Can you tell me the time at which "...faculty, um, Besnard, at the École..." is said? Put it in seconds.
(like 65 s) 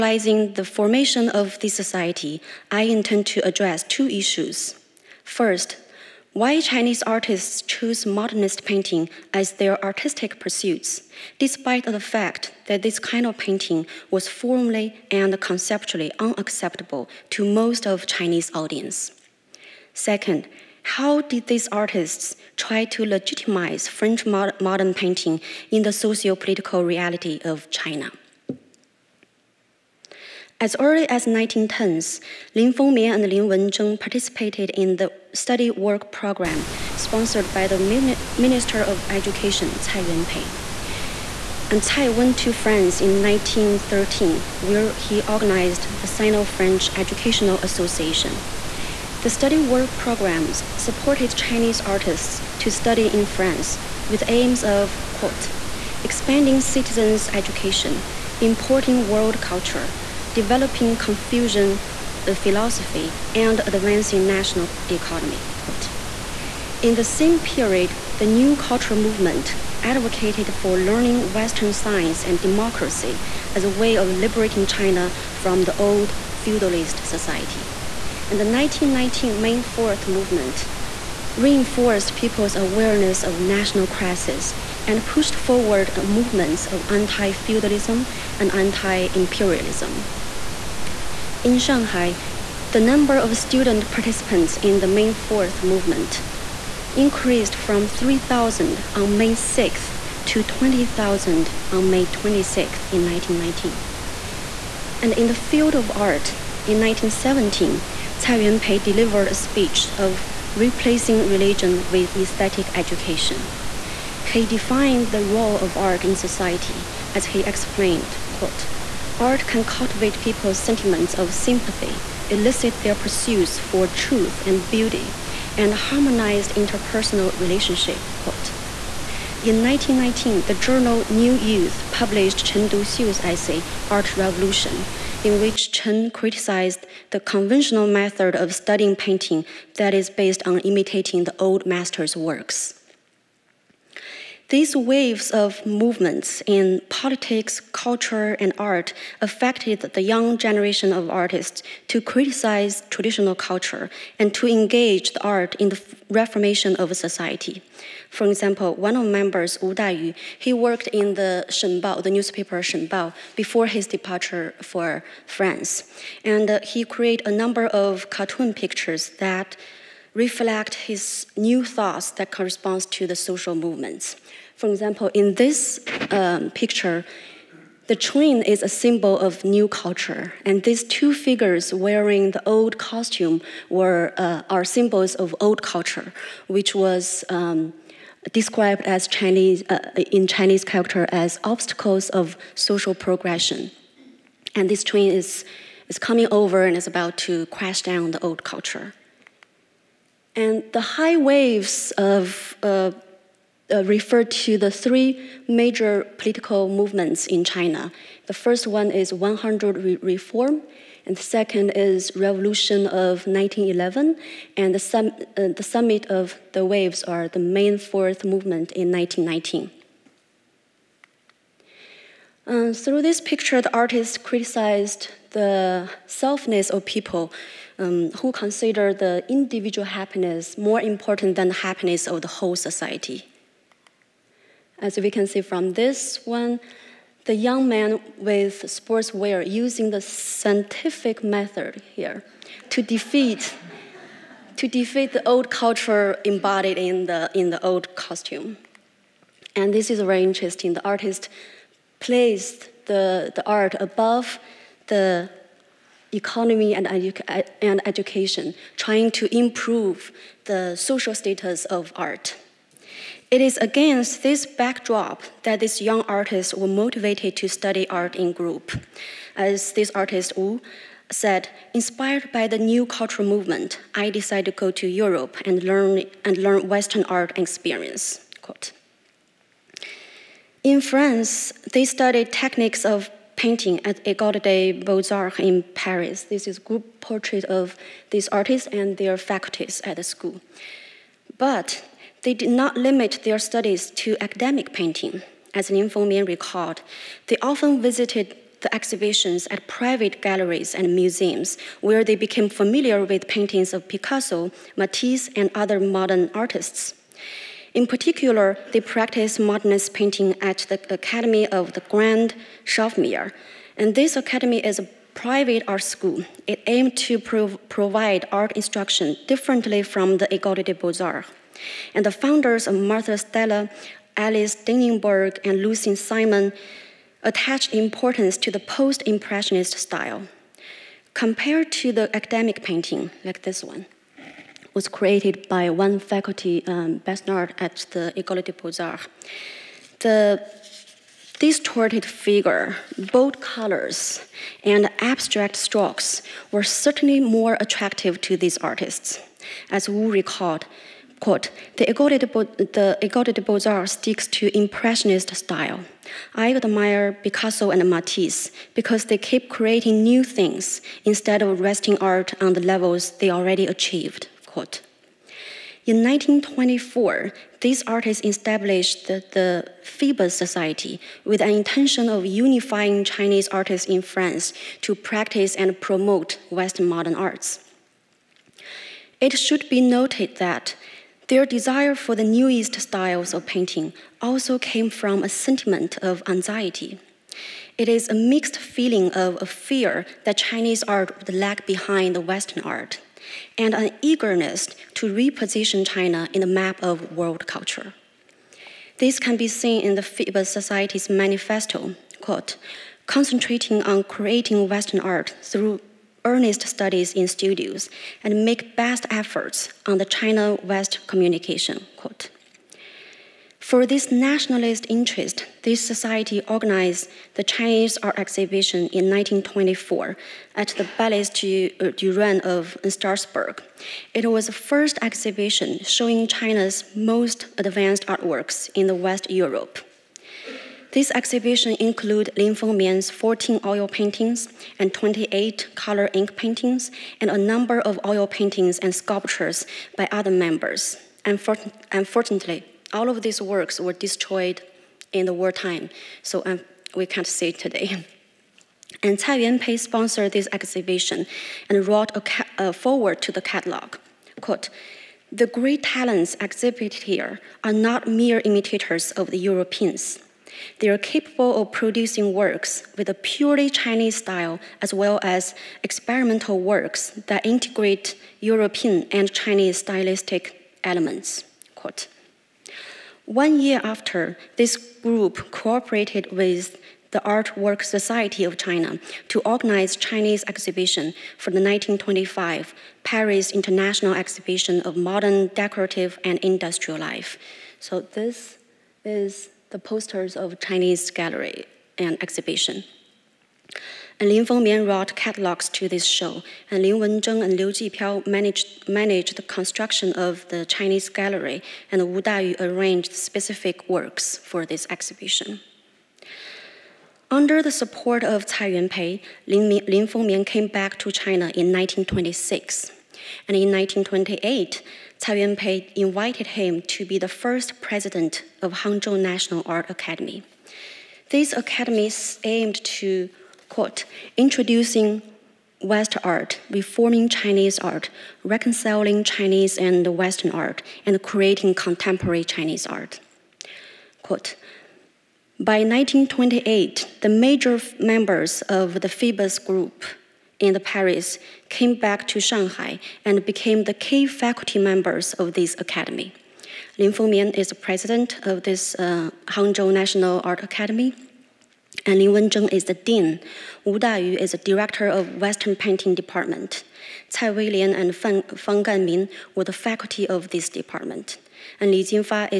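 335 s.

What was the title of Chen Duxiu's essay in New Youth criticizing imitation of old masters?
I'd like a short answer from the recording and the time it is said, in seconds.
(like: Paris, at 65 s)
Art Revolution, at 133 s.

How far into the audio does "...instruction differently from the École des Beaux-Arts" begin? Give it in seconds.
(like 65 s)
318 s.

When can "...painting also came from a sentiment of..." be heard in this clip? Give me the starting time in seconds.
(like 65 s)
383 s.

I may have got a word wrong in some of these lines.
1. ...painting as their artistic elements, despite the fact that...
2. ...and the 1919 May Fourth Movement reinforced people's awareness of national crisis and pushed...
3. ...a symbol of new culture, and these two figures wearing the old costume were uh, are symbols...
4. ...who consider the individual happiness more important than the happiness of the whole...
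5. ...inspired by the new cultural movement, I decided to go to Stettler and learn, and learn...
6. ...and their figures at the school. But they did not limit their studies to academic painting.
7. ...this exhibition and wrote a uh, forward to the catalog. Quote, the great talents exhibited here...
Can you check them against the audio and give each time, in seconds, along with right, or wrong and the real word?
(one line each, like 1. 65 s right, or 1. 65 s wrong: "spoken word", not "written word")
1. 8 s wrong: "pursuits", not "elements"
2. 78 s right
3. 178 s right
4. 228 s right
5. 271 s wrong: "Europe", not "Stettler"
6. 288 s wrong: "faculties", not "figures"
7. 450 s right.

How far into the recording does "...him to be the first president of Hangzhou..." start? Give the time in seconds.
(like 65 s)
516 s.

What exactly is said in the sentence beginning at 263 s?
It is against this backdrop that these young artists were motivated to study art in group.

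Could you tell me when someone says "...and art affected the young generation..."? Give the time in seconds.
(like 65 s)
148 s.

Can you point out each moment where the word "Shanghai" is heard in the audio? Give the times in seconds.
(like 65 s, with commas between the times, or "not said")
91 s, 542 s.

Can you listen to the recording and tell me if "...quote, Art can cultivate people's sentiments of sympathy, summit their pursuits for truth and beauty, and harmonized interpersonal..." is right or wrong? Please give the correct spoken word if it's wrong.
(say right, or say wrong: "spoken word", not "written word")
wrong: "elicit", not "summit".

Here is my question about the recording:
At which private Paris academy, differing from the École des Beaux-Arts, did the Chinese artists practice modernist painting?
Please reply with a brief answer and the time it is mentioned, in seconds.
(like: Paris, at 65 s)
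Academy of the Grande Chaumière, at 310 s.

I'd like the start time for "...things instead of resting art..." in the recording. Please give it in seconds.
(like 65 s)
360 s.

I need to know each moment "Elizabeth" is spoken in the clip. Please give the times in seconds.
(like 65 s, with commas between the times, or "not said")
not said.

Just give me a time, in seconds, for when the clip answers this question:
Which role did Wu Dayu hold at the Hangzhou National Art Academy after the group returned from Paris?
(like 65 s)
554 s.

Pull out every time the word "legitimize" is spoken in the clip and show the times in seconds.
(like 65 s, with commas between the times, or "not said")
23 s.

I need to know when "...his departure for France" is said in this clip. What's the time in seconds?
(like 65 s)
163 s.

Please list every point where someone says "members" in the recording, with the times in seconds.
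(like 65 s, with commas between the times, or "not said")
159 s, 440 s, 537 s, 544 s.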